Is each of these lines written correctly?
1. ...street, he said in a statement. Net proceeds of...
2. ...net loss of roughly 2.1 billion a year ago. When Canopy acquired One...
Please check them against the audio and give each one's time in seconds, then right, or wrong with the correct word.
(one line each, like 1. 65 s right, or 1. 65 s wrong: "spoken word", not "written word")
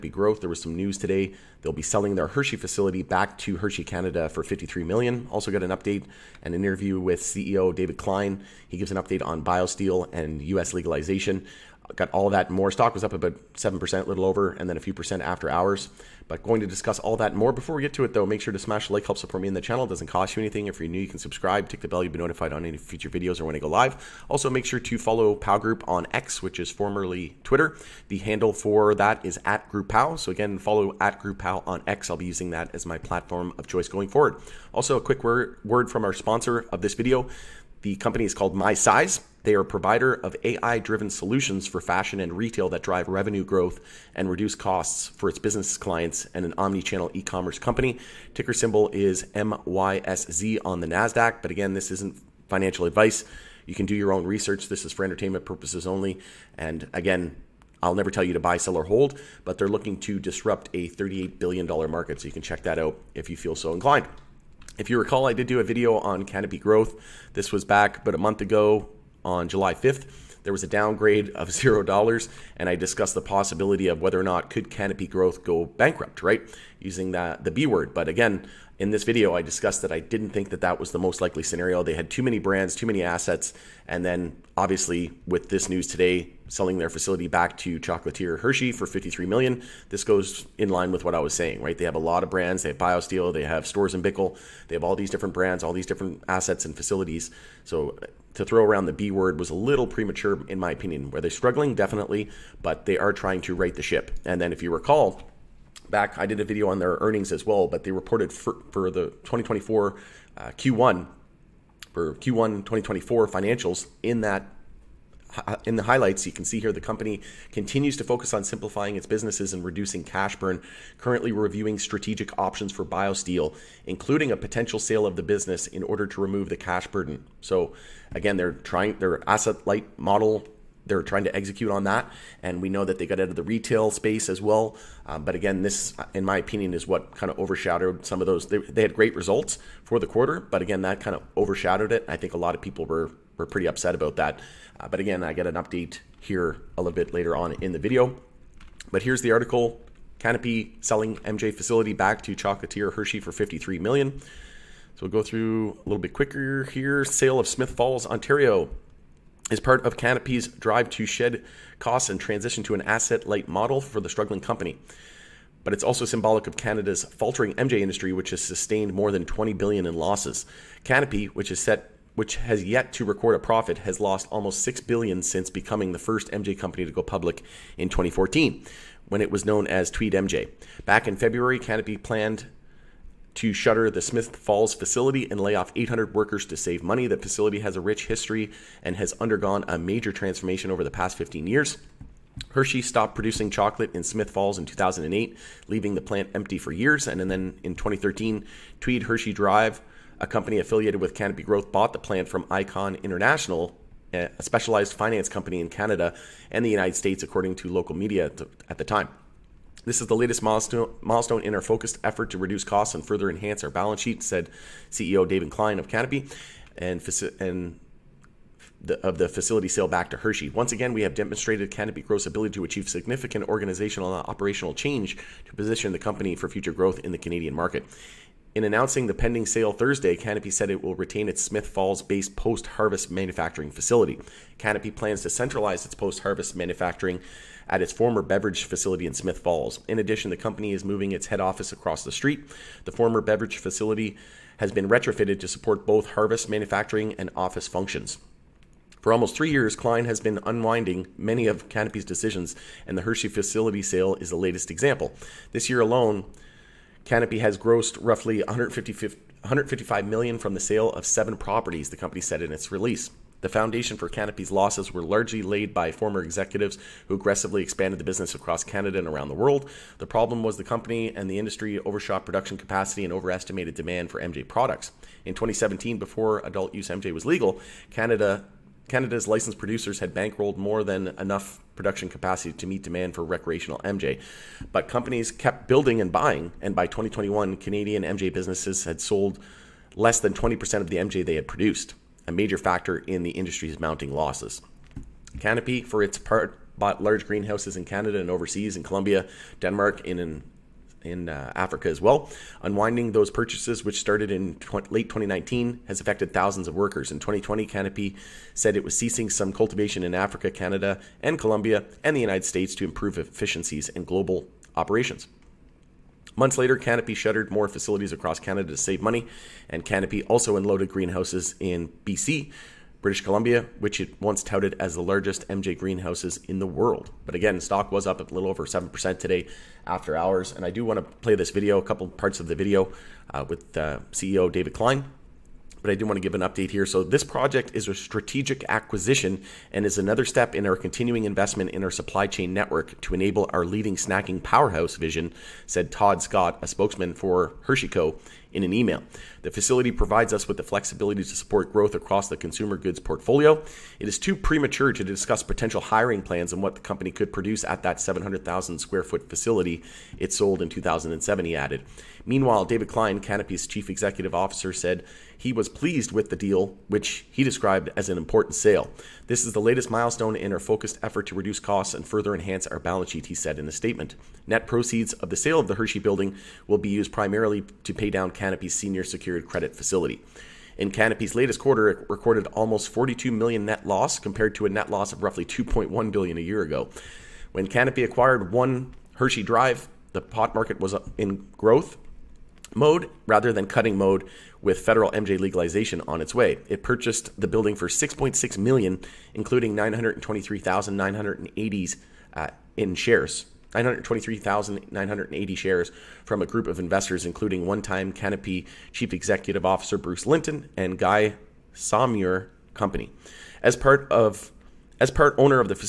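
1. 373 s wrong: "sheet", not "street"
2. 384 s right.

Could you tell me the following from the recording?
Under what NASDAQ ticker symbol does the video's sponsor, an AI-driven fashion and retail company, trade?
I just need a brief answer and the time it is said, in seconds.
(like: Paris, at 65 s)
MYSZ, at 49 s.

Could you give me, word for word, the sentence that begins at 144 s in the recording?
Uh, but again, I get an update here a little bit later on in the video.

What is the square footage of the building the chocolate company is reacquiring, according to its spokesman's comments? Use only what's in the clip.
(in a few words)
700,000 square feet.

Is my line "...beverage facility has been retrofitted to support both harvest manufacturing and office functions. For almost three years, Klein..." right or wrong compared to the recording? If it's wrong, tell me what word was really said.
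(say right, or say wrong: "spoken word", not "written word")
right.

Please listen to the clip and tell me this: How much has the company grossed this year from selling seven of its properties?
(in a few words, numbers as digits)
155 million.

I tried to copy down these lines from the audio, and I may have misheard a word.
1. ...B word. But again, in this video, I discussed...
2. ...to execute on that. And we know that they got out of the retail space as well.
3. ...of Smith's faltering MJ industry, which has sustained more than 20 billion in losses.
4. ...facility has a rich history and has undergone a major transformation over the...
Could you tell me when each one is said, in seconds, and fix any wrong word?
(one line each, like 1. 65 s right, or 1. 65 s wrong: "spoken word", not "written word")
1. 77 s right
2. 131 s right
3. 166 s wrong: "Canada", not "Smith"
4. 187 s right.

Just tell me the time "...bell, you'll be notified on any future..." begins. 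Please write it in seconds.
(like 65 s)
21 s.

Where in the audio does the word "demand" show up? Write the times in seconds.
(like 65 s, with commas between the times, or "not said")
273 s, 282 s.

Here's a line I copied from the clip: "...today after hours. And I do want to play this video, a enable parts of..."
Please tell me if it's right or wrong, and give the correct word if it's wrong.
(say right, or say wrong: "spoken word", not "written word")
wrong: "couple", not "enable".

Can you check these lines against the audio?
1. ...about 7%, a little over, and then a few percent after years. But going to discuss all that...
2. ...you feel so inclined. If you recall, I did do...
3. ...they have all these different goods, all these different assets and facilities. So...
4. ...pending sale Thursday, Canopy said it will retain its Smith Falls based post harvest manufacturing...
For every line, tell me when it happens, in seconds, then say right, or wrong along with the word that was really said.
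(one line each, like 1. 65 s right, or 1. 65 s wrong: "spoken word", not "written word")
1. 13 s wrong: "hours", not "years"
2. 63 s right
3. 94 s wrong: "brands", not "goods"
4. 229 s right.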